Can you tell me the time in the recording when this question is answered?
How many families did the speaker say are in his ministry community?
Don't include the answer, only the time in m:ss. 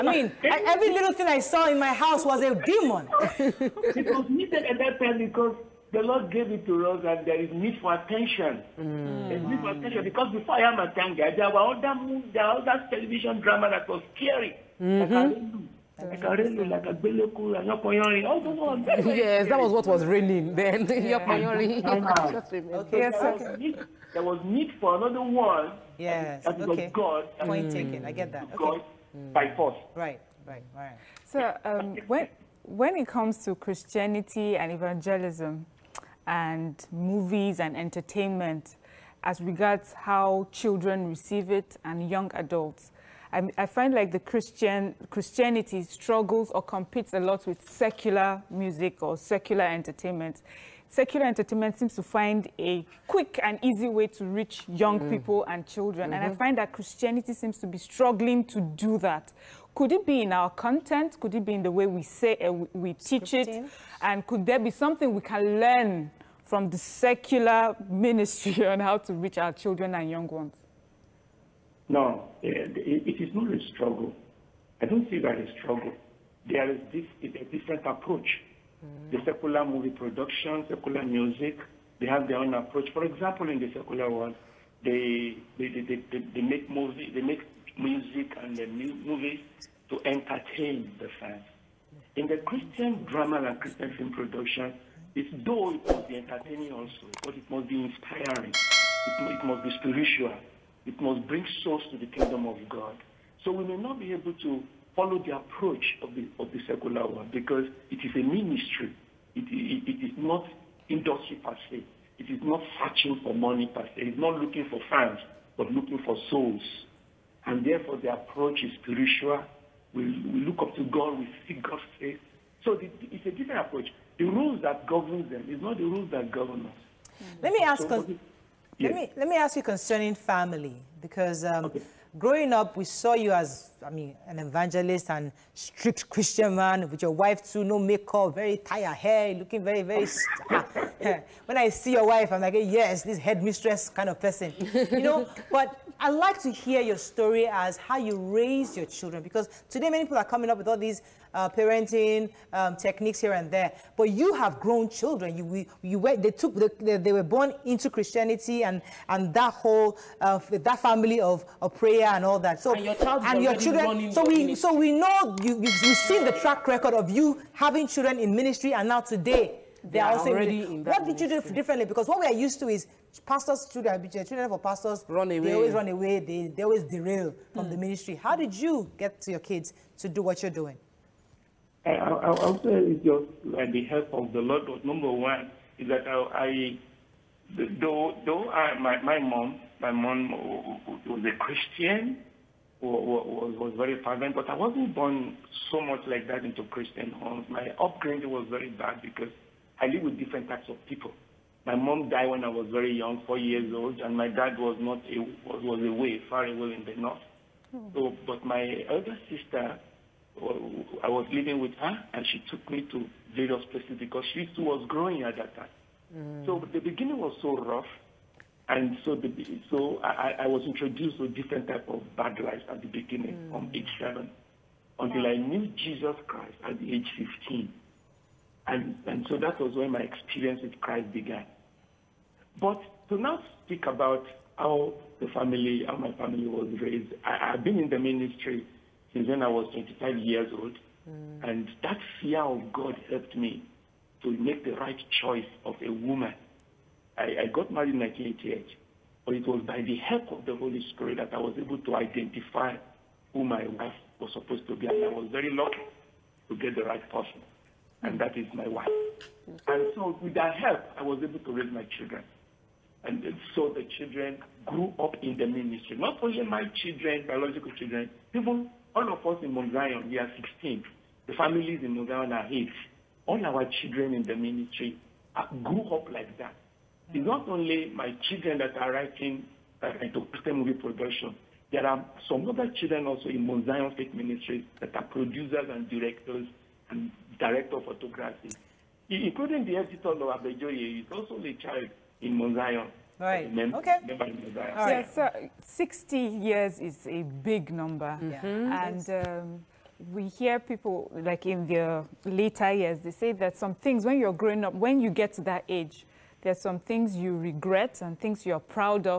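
4:32.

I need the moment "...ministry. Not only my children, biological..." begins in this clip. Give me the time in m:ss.
4:25.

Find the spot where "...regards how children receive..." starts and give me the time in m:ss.
0:39.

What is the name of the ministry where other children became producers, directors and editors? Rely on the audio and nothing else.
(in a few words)
Mount Zion Faith Ministries.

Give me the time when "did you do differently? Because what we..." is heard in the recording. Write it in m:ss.
2:51.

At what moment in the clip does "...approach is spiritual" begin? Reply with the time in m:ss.
1:58.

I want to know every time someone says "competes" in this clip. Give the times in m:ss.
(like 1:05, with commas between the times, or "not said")
0:46.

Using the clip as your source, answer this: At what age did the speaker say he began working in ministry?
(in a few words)
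25.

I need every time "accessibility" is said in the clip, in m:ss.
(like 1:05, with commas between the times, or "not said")
not said.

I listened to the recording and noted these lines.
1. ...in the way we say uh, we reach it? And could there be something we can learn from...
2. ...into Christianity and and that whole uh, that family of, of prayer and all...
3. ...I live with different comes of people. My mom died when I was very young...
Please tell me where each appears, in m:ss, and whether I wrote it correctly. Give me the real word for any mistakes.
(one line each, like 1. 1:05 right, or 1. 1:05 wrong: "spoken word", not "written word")
1. 1:01 wrong: "teach", not "reach"
2. 2:37 right
3. 3:19 wrong: "types", not "comes".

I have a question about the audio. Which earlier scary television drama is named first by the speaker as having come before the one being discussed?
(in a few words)
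Agbeleku.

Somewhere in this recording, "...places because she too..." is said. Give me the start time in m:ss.
3:33.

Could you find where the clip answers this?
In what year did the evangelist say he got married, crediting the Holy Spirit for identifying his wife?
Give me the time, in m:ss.
4:07.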